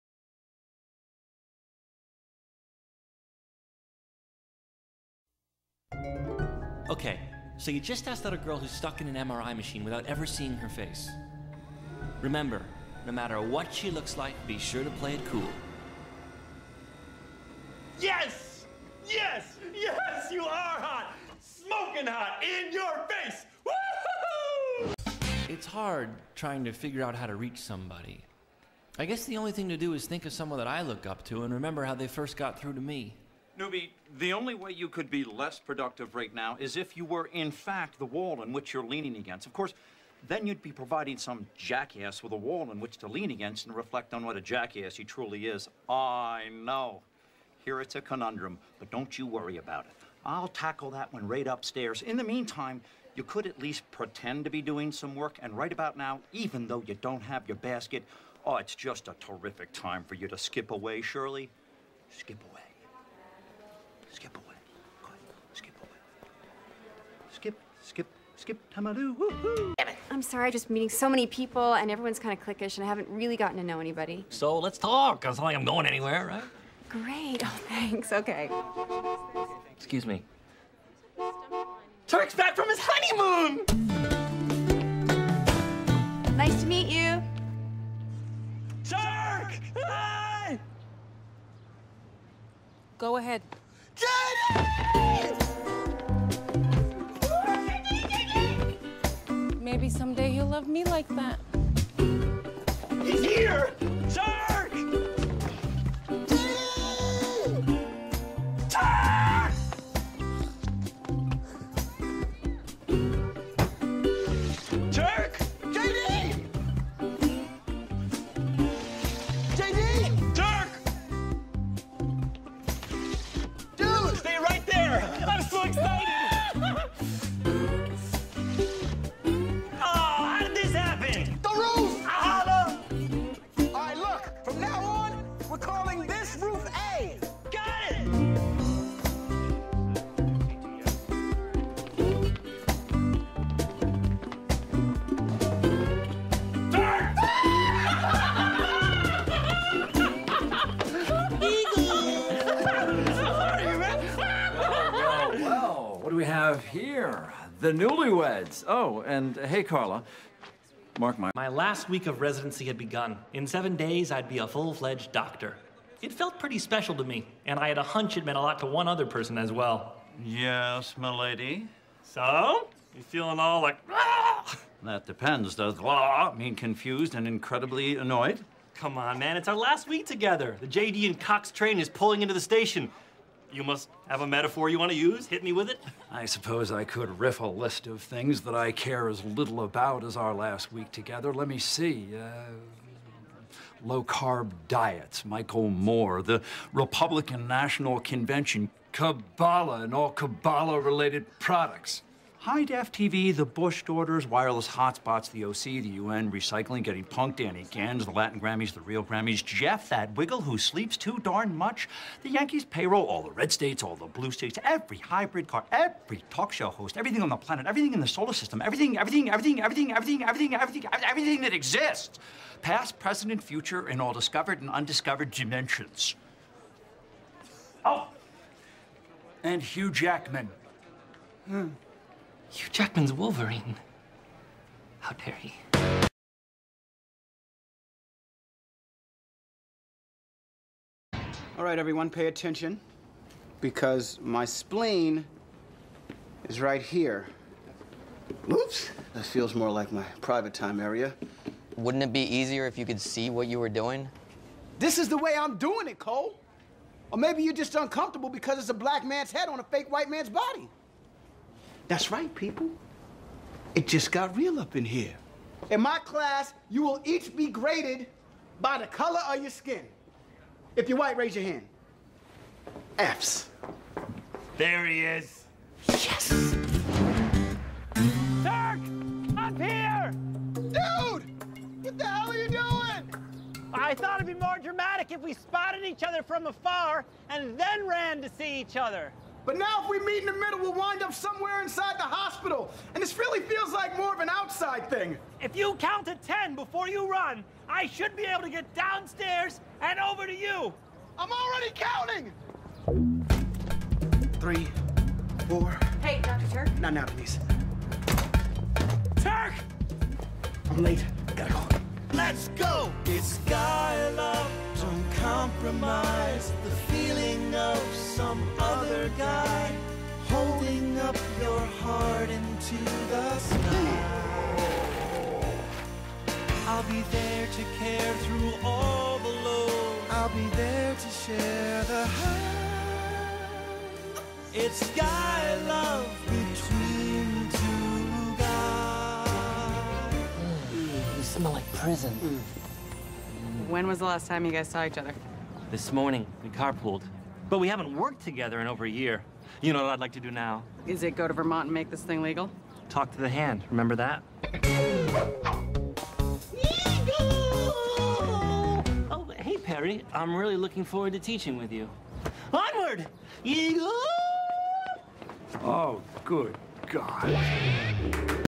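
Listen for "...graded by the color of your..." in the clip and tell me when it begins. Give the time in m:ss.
4:27.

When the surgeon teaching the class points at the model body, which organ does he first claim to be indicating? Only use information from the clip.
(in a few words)
spleen.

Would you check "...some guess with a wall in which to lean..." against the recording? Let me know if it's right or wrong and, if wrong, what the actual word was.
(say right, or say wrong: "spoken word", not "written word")
wrong: "jackass", not "guess".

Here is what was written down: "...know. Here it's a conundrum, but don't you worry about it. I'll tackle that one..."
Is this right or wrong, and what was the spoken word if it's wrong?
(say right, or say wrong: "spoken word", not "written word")
right.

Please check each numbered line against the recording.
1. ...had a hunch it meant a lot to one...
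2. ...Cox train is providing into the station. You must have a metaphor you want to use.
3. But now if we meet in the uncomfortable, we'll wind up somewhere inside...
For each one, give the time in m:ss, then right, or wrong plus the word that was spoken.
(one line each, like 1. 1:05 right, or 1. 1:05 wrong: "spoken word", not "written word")
1. 2:47 right
2. 3:01 wrong: "pulling", not "providing"
3. 4:49 wrong: "middle", not "uncomfortable".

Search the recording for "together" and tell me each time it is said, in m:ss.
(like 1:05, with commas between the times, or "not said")
3:00, 3:10, 5:48.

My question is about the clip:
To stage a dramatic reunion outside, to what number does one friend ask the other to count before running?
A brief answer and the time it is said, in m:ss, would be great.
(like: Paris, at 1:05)
10, at 4:56.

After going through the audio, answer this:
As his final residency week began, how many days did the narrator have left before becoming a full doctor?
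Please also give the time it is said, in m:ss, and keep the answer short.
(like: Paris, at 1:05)
7, at 2:43.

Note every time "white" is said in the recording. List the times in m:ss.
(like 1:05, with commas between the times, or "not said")
4:19, 4:30.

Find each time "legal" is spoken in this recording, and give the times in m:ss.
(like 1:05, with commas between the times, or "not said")
5:52.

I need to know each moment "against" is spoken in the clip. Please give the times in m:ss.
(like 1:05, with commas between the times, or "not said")
0:39, 0:43.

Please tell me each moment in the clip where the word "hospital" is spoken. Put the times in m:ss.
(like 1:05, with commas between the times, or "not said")
4:52.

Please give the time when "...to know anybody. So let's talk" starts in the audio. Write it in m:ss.
1:13.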